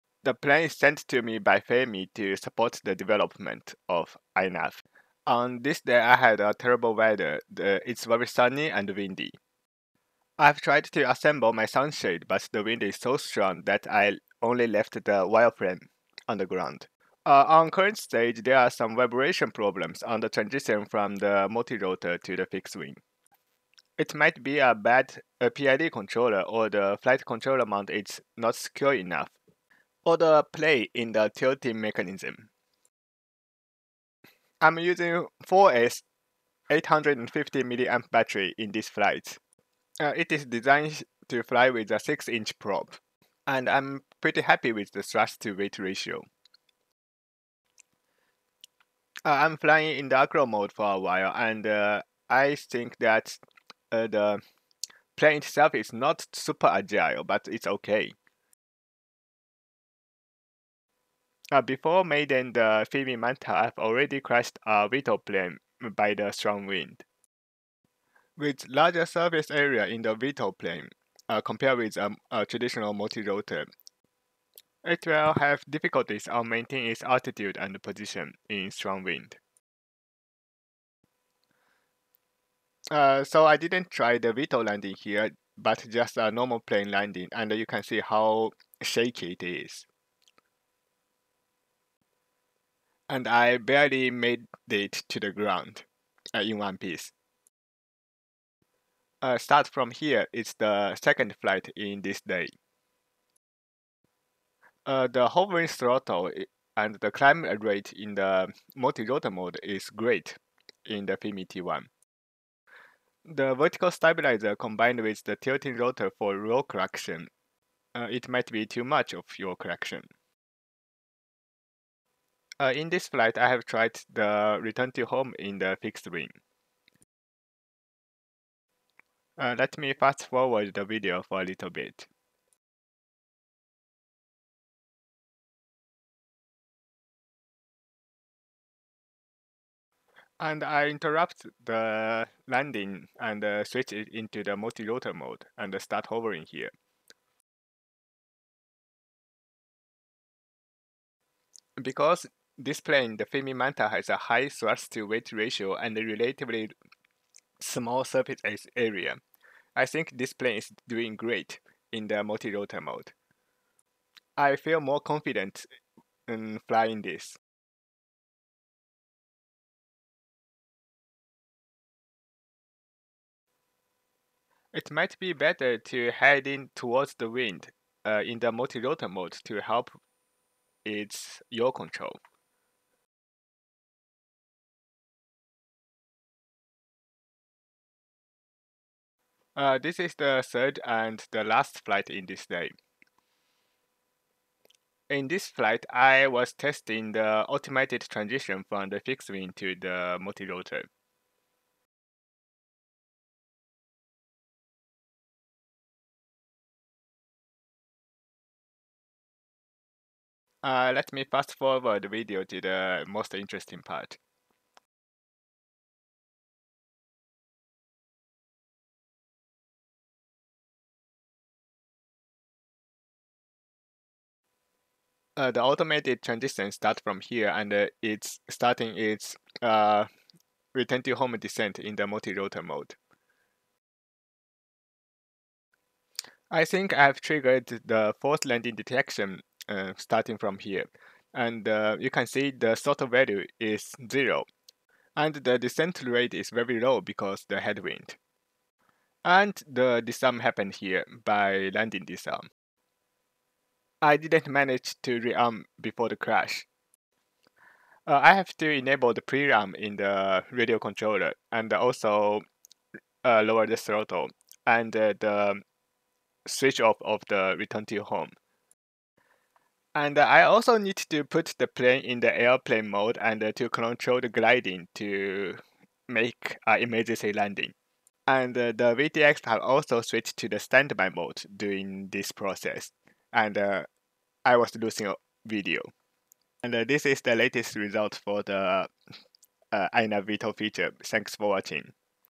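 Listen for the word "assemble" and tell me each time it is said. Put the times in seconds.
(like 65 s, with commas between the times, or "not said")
11 s.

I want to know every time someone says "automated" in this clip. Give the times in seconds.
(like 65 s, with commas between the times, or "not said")
197 s, 225 s.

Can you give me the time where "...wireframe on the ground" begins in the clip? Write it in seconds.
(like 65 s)
15 s.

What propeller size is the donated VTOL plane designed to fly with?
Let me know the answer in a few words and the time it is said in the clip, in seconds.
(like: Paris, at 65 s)
6 inch, at 41 s.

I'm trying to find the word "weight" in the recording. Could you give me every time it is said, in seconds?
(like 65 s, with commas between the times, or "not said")
45 s, 155 s.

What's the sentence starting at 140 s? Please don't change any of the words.
And I interrupt the landing and uh, switch it into the multi-rotor mode and start hovering here.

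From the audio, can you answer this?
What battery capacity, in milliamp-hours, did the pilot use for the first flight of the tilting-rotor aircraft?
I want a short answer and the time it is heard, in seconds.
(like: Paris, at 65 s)
850 mAh, at 36 s.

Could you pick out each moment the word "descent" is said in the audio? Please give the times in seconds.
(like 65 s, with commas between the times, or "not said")
231 s, 245 s.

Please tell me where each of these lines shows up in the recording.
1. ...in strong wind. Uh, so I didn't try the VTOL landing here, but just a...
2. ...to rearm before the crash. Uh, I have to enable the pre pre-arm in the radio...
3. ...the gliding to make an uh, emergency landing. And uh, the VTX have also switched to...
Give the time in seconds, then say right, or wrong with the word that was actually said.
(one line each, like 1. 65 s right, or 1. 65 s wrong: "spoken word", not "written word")
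1. 78 s right
2. 255 s right
3. 274 s right.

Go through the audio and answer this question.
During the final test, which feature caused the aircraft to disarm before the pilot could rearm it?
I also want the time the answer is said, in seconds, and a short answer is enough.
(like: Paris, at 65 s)
landing disarm, at 251 s.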